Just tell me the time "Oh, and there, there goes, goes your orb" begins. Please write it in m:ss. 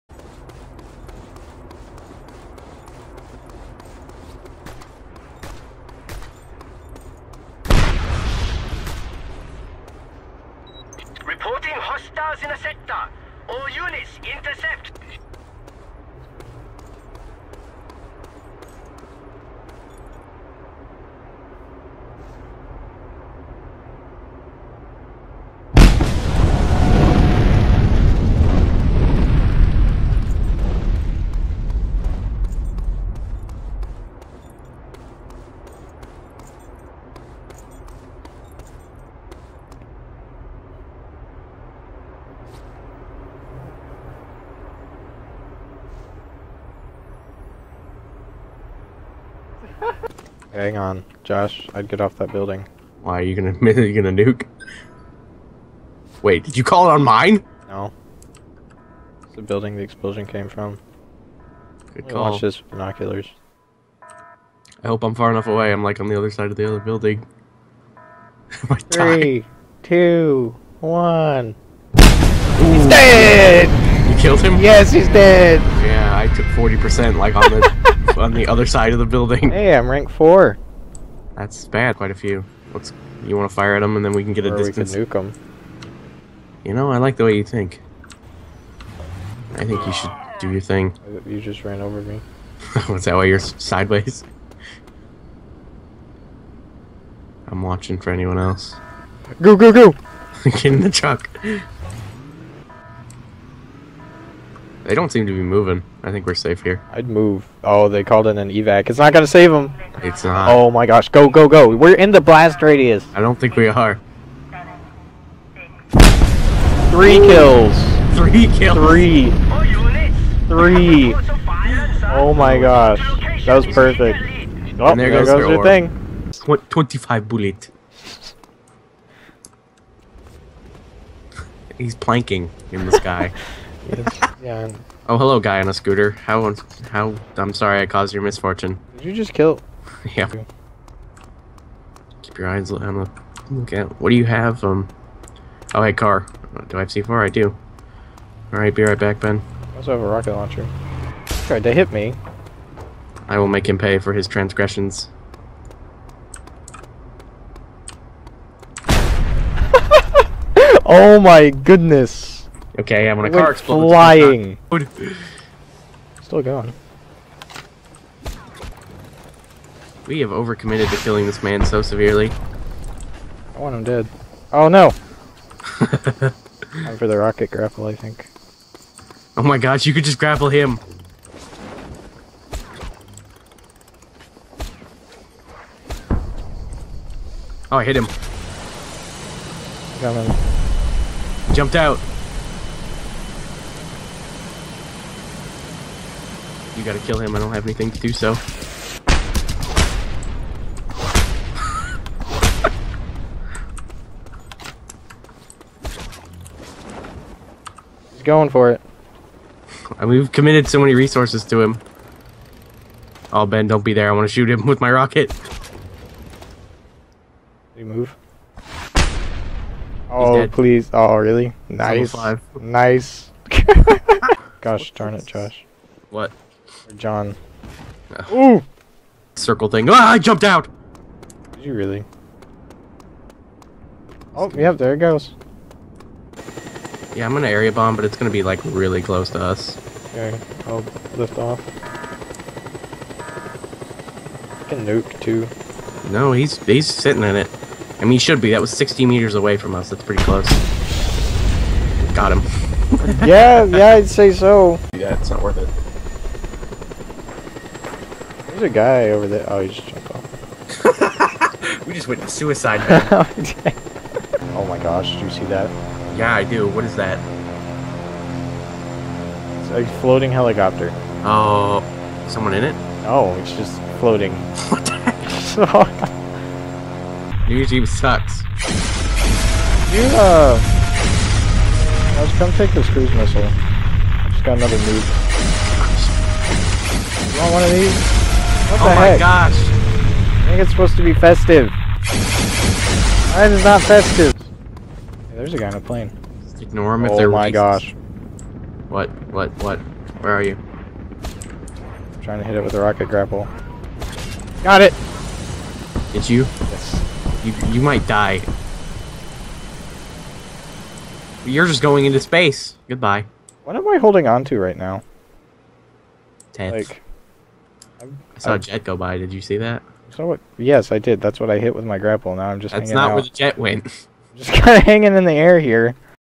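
2:04.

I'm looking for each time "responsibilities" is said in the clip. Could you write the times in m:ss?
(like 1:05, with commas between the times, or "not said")
not said.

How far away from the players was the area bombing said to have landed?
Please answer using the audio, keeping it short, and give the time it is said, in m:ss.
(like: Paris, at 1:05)
60 meters, at 4:08.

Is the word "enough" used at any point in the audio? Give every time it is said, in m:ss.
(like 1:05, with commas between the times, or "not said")
1:05.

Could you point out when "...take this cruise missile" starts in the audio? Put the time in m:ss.
4:42.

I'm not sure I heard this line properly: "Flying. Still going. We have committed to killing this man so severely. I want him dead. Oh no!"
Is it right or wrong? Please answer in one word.
wrong.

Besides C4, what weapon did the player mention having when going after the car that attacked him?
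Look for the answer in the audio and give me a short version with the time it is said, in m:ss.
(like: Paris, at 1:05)
Rocket launcher, at 2:30.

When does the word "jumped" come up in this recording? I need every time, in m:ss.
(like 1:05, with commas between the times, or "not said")
3:11, 3:50, 4:19.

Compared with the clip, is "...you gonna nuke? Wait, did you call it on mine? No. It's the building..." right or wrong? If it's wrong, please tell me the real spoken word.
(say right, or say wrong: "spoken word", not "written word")
right.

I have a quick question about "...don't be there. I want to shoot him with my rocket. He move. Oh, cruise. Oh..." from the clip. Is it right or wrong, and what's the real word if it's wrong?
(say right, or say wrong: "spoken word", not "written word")
wrong: "please", not "cruise".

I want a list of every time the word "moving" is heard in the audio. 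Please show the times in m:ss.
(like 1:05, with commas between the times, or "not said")
1:45.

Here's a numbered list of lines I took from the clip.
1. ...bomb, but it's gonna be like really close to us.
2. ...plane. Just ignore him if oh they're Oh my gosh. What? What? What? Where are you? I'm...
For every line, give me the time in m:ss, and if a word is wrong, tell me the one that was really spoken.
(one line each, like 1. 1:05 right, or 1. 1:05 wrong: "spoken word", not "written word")
1. 3:57 right
2. 4:55 right.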